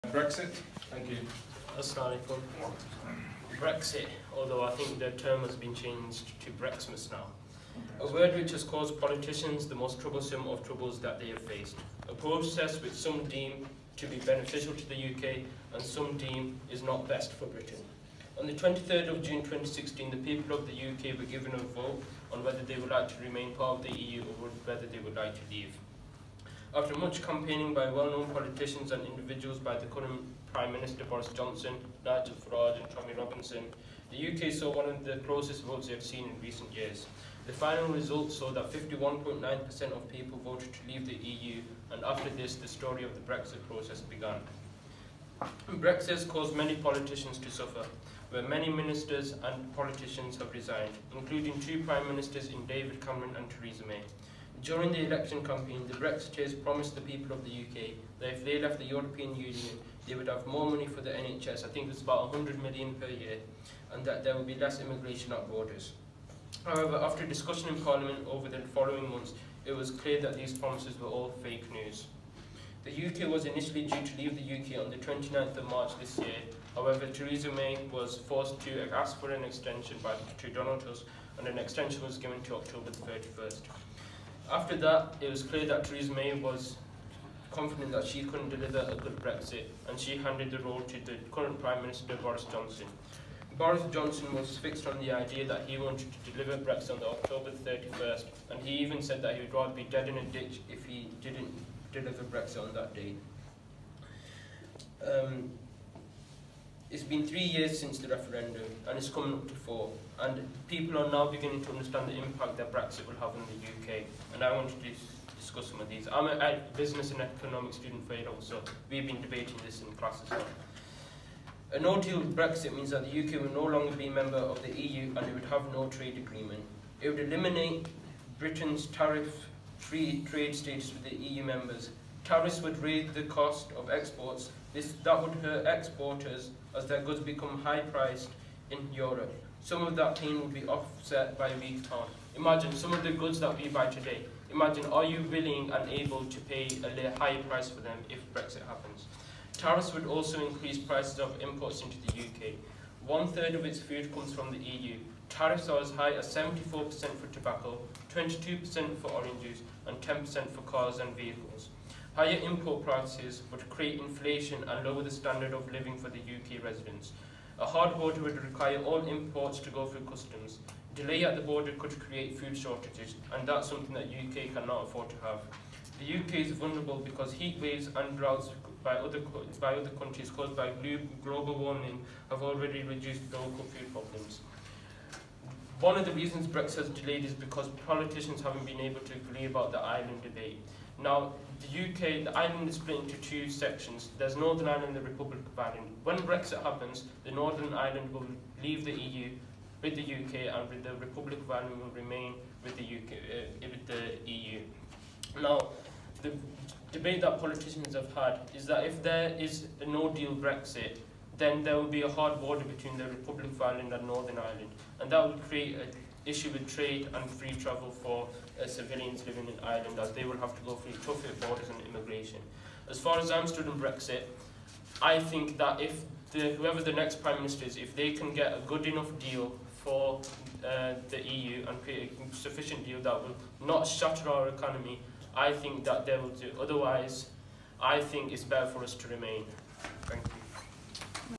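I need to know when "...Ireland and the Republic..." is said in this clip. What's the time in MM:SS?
03:14.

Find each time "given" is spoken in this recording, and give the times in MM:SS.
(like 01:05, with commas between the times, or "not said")
00:21, 01:22.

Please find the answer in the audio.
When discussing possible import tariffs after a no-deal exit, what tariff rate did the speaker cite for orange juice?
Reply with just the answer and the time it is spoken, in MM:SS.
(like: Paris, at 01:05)
22%, at 02:38.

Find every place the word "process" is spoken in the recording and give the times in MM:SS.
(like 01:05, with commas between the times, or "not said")
00:12, 00:43.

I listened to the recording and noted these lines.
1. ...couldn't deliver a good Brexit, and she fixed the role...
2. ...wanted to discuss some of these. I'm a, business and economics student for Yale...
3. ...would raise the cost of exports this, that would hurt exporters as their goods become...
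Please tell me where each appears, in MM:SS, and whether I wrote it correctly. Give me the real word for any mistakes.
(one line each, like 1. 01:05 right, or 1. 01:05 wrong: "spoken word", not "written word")
1. 01:28 wrong: "handed", not "fixed"
2. 01:54 right
3. 02:12 right.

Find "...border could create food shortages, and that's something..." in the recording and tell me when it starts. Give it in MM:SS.
02:51.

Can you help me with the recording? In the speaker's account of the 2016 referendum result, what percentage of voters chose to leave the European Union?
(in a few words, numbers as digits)
51.9%.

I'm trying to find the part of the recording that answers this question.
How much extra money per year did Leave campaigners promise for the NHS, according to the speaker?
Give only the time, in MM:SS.
01:02.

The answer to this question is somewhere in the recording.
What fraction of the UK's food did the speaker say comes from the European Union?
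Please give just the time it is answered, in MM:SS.
02:33.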